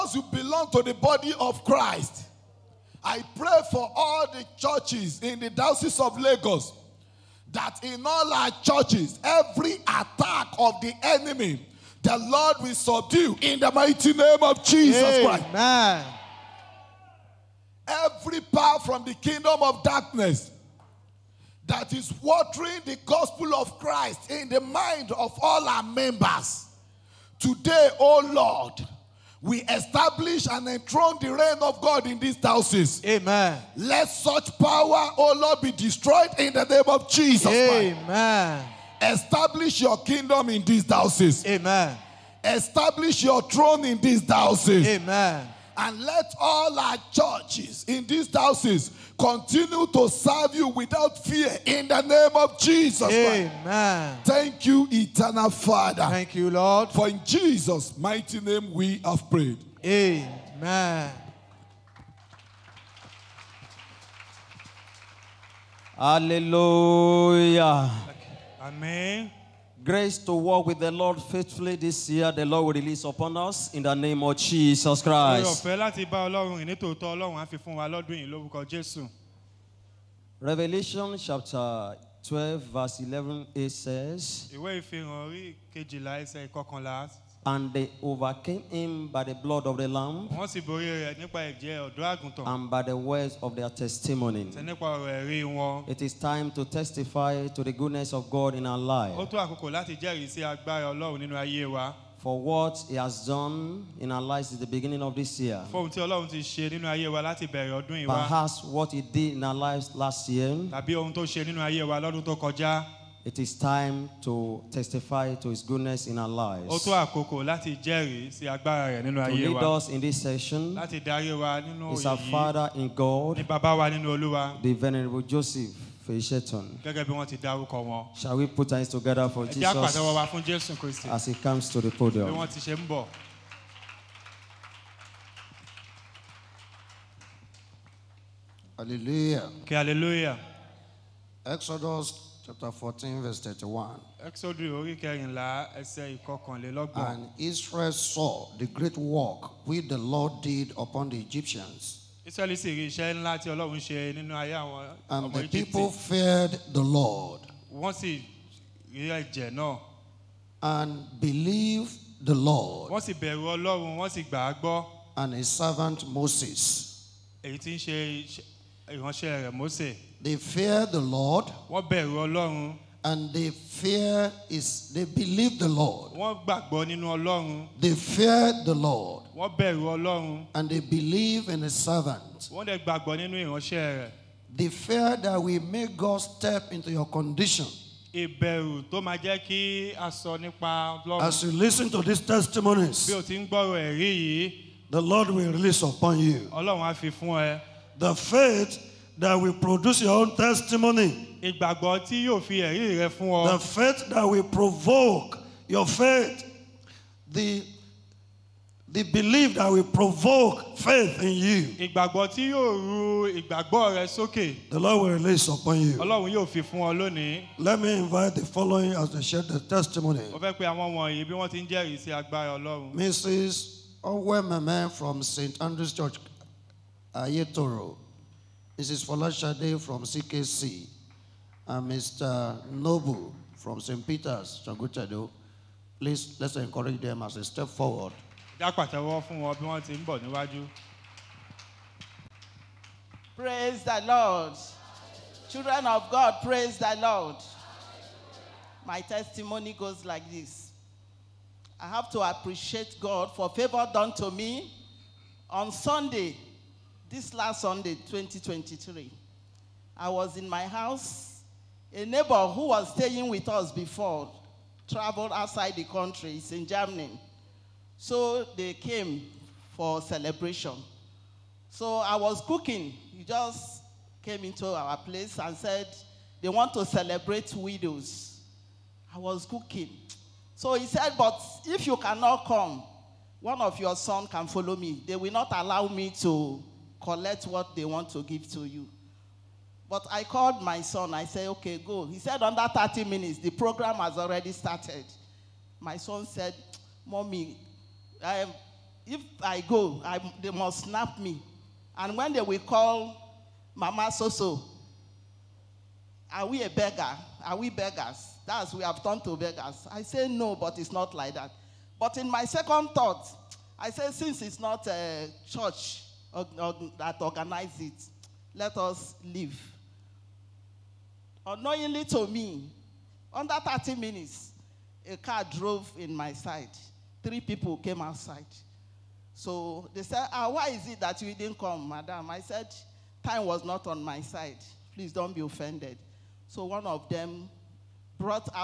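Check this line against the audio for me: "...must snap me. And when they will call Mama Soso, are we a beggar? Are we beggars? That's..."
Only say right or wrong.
right.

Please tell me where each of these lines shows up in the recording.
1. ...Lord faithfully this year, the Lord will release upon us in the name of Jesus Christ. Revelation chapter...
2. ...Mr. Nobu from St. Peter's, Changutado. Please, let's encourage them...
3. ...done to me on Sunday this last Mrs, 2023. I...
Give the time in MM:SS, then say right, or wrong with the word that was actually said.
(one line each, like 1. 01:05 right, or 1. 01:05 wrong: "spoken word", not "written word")
1. 01:10 right
2. 03:51 right
3. 04:13 wrong: "Sunday", not "Mrs".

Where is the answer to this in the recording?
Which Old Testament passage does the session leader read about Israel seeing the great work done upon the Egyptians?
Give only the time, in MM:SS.
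02:21.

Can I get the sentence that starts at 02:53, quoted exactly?
And they fear is they believe the Lord.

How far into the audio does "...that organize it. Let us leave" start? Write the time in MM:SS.
05:16.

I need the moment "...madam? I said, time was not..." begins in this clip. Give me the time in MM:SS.
05:31.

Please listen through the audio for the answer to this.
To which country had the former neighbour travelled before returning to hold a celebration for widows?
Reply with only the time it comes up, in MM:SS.
04:26.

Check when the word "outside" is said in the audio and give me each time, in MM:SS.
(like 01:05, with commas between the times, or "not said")
04:25, 05:28.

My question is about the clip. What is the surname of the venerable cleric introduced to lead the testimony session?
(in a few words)
Fèyíṣẹ́tàn.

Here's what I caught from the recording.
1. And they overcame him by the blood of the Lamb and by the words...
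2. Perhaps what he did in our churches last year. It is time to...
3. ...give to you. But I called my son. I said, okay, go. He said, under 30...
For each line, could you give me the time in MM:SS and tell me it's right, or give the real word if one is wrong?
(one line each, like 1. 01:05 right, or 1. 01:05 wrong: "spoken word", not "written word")
1. 01:27 right
2. 01:48 wrong: "lives", not "churches"
3. 04:48 right.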